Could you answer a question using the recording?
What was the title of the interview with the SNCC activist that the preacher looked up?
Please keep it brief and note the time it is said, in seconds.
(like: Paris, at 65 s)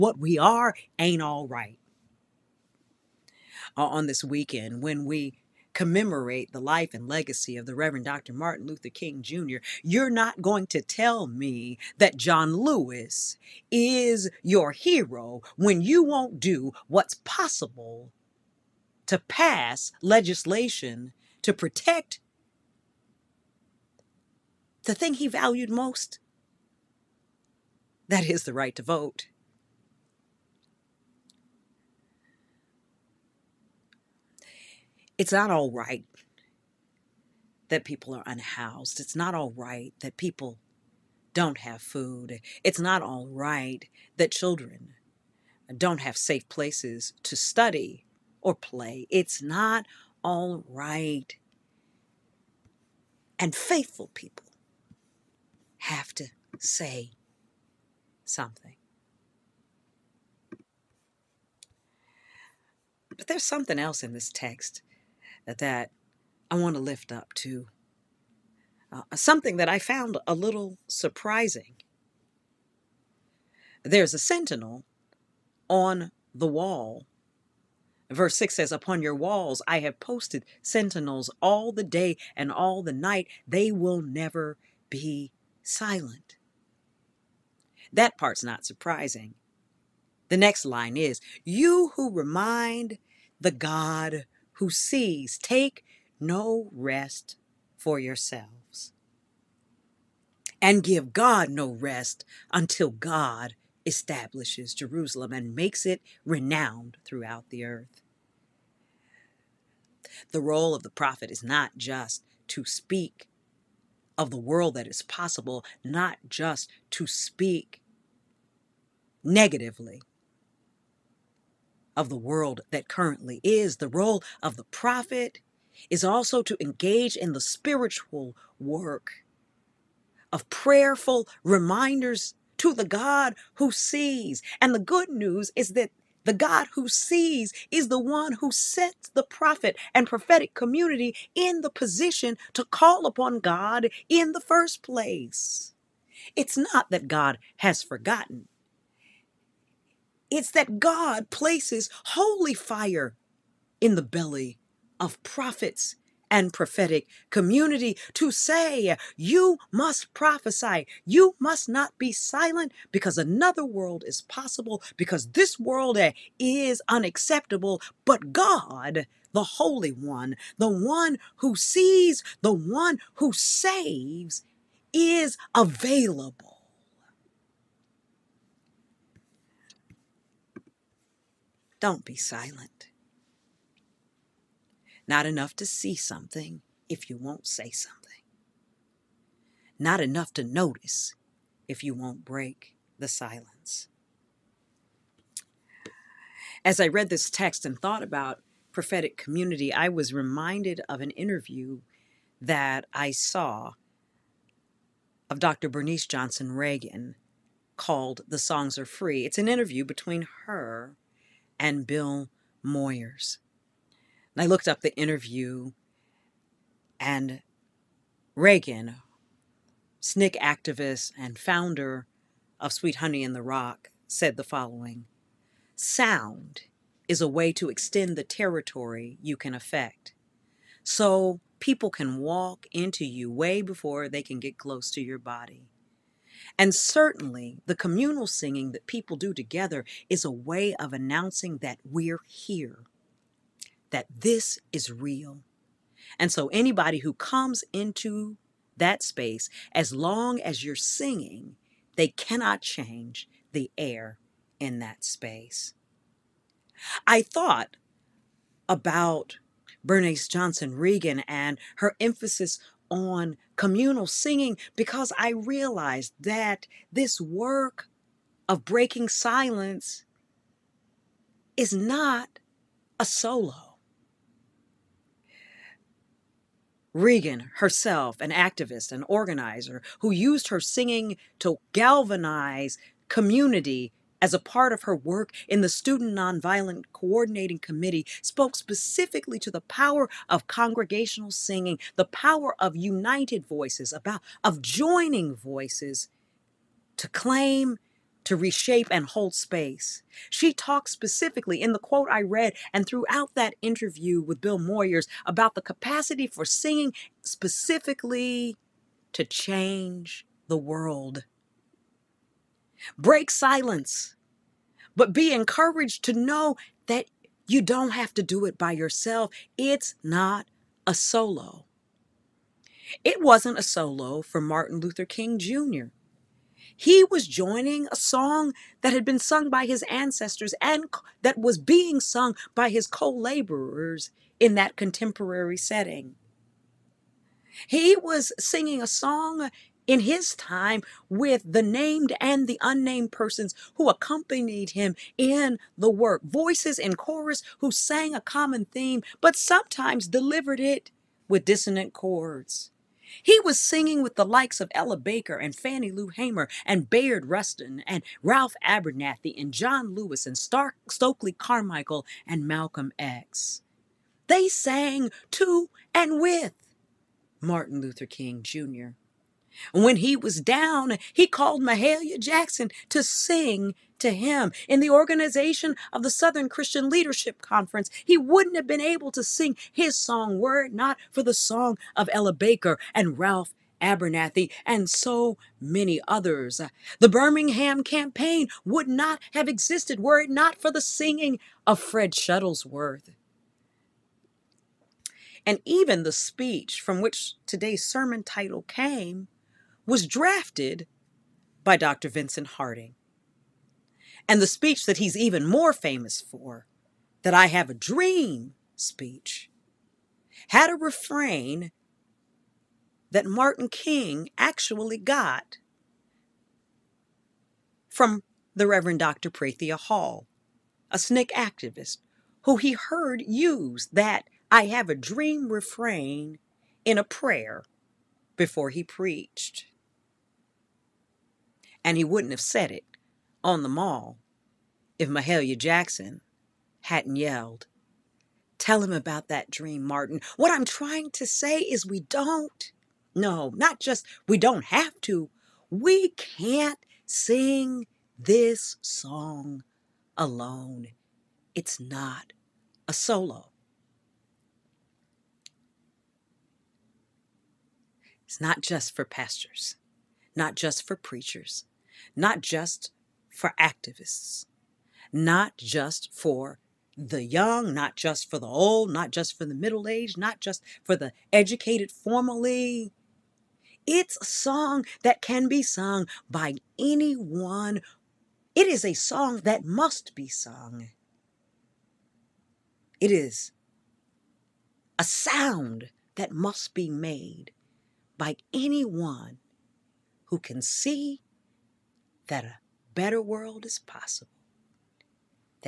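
The Songs Are Free, at 208 s.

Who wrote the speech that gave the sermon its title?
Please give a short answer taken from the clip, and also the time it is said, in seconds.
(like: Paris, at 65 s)
Vincent Harding, at 401 s.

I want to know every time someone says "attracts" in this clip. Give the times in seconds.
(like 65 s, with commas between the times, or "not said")
not said.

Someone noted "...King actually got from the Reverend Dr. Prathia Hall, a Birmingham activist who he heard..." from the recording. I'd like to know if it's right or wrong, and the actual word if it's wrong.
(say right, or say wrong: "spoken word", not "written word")
wrong: "SNCC", not "Birmingham".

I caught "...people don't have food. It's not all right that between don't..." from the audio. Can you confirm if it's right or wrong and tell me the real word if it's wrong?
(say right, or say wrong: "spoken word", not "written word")
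wrong: "children", not "between".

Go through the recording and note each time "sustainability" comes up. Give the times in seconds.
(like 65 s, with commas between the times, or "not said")
not said.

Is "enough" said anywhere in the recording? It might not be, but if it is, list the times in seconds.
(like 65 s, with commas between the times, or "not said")
185 s, 189 s.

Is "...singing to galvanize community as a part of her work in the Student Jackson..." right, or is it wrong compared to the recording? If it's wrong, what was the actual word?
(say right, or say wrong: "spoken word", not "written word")
wrong: "Nonviolent", not "Jackson".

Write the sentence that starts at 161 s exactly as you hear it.
You must not be silent because another world is possible, because this world eh, is unacceptable.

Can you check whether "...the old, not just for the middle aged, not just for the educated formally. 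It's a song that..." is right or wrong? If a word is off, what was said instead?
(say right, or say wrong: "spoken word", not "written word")
right.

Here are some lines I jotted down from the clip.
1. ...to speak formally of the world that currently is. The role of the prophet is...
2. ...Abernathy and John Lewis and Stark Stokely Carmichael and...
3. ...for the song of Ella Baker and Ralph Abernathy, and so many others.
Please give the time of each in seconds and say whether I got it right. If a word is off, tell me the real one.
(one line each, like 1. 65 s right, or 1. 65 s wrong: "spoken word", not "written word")
1. 116 s wrong: "negatively", not "formally"
2. 358 s right
3. 381 s right.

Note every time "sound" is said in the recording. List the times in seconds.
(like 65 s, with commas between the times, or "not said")
225 s, 485 s.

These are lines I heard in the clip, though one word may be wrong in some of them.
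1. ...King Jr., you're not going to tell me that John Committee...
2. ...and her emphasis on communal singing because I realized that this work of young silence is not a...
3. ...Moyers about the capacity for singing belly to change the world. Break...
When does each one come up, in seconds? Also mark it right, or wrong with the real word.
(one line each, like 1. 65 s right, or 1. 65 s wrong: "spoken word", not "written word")
1. 8 s wrong: "Lewis", not "Committee"
2. 261 s wrong: "breaking", not "young"
3. 304 s wrong: "specifically", not "belly".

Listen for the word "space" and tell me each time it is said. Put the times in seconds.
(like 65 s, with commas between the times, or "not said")
249 s, 255 s, 299 s.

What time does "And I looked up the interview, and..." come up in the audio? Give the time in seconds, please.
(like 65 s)
214 s.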